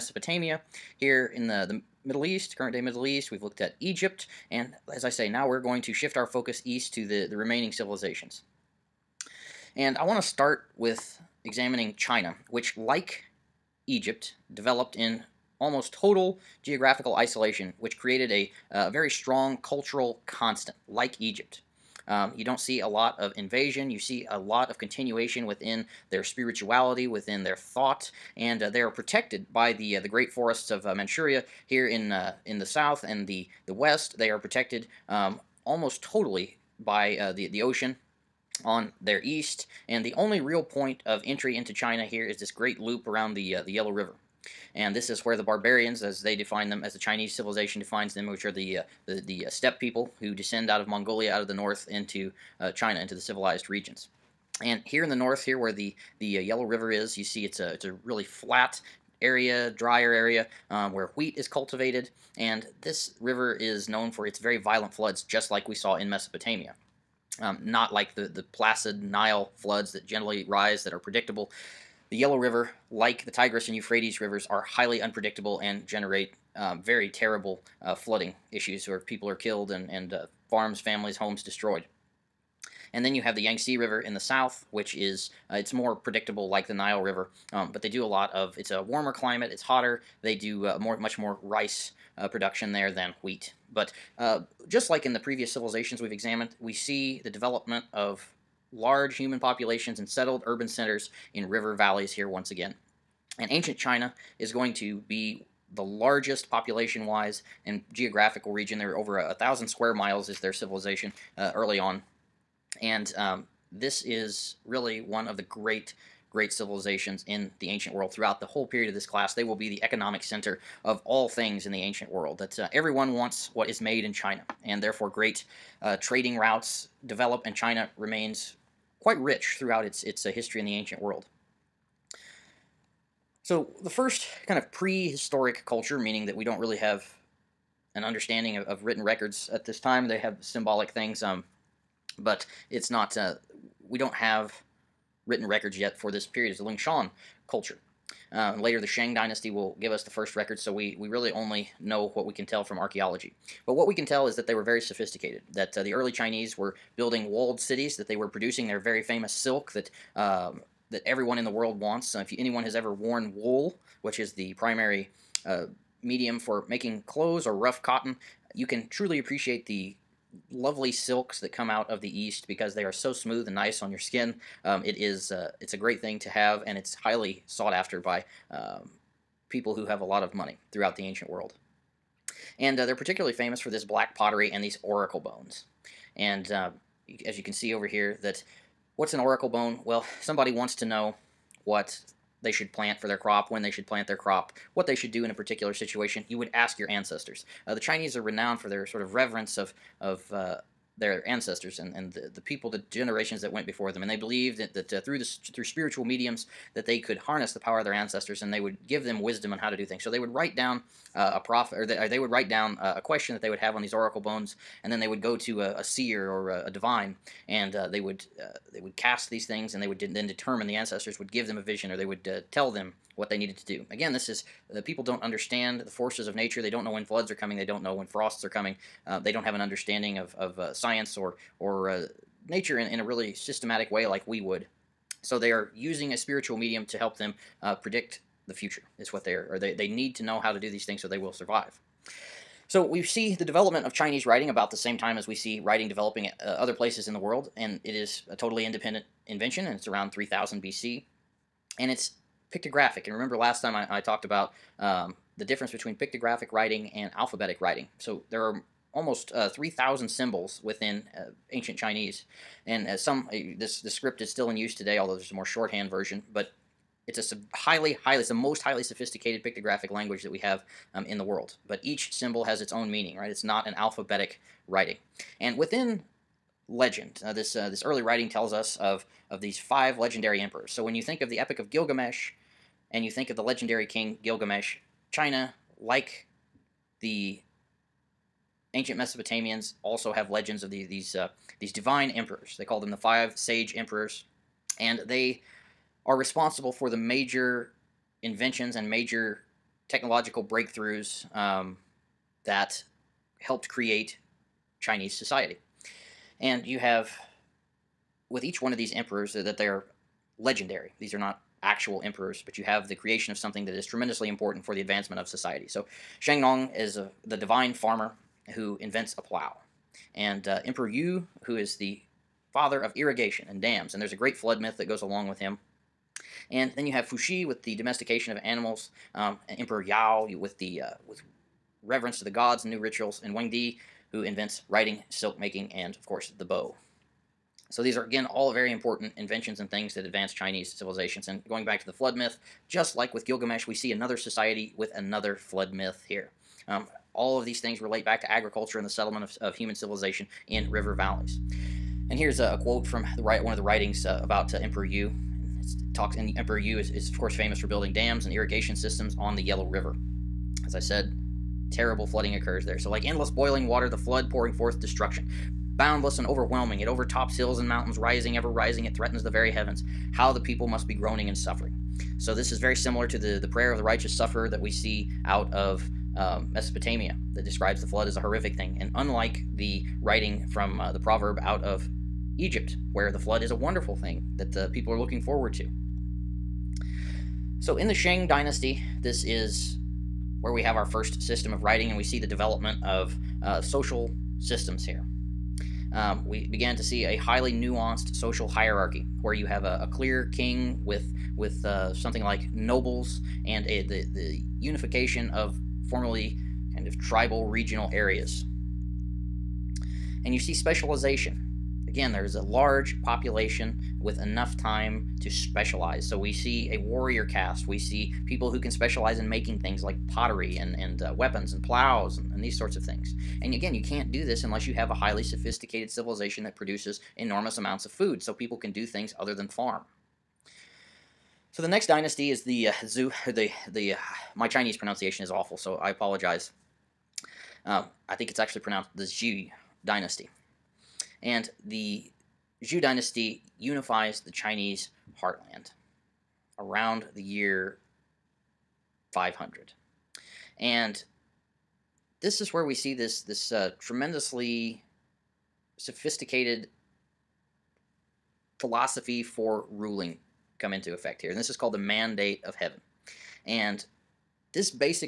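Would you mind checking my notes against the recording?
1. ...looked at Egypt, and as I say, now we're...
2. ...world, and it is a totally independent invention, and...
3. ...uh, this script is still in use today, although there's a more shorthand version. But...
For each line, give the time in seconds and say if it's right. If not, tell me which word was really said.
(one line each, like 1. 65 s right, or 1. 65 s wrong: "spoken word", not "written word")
1. 3 s right
2. 247 s right
3. 263 s right.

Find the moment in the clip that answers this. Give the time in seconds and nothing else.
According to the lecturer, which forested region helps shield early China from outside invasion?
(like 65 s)
30 s.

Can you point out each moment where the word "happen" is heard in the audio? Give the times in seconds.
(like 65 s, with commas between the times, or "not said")
not said.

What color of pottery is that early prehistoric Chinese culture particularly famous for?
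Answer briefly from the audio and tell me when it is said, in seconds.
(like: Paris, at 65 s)
Black, at 183 s.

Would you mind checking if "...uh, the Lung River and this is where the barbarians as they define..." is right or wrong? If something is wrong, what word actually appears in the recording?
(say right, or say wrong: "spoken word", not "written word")
wrong: "Yellow", not "Lung".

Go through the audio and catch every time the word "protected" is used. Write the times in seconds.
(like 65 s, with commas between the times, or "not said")
28 s, 34 s.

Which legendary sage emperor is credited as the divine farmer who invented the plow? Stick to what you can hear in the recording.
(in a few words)
Shang Nong.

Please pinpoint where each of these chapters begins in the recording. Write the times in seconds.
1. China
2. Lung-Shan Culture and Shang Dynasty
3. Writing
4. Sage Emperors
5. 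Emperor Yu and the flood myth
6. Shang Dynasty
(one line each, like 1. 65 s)
1. 9 s
2. 146 s
3. 239 s
4. 280 s
5. 339 s
6. 390 s.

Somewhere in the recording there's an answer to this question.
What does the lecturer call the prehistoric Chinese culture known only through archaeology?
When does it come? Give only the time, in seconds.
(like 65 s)
146 s.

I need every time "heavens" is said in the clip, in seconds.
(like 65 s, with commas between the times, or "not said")
369 s, 462 s.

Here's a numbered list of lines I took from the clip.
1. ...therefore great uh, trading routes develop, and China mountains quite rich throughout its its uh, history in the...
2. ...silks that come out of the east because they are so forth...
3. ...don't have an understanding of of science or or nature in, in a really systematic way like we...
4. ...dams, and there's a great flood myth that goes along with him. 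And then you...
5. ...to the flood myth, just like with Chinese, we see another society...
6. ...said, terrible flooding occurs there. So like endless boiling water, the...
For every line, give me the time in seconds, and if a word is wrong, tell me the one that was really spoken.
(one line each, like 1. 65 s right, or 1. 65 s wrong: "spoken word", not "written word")
1. 124 s wrong: "remains", not "mountains"
2. 170 s wrong: "smooth", not "forth"
3. 229 s right
4. 323 s right
5. 341 s wrong: "Gilgamesh", not "Chinese"
6. 360 s right.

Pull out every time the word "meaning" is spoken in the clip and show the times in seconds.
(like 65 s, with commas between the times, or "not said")
135 s, 272 s.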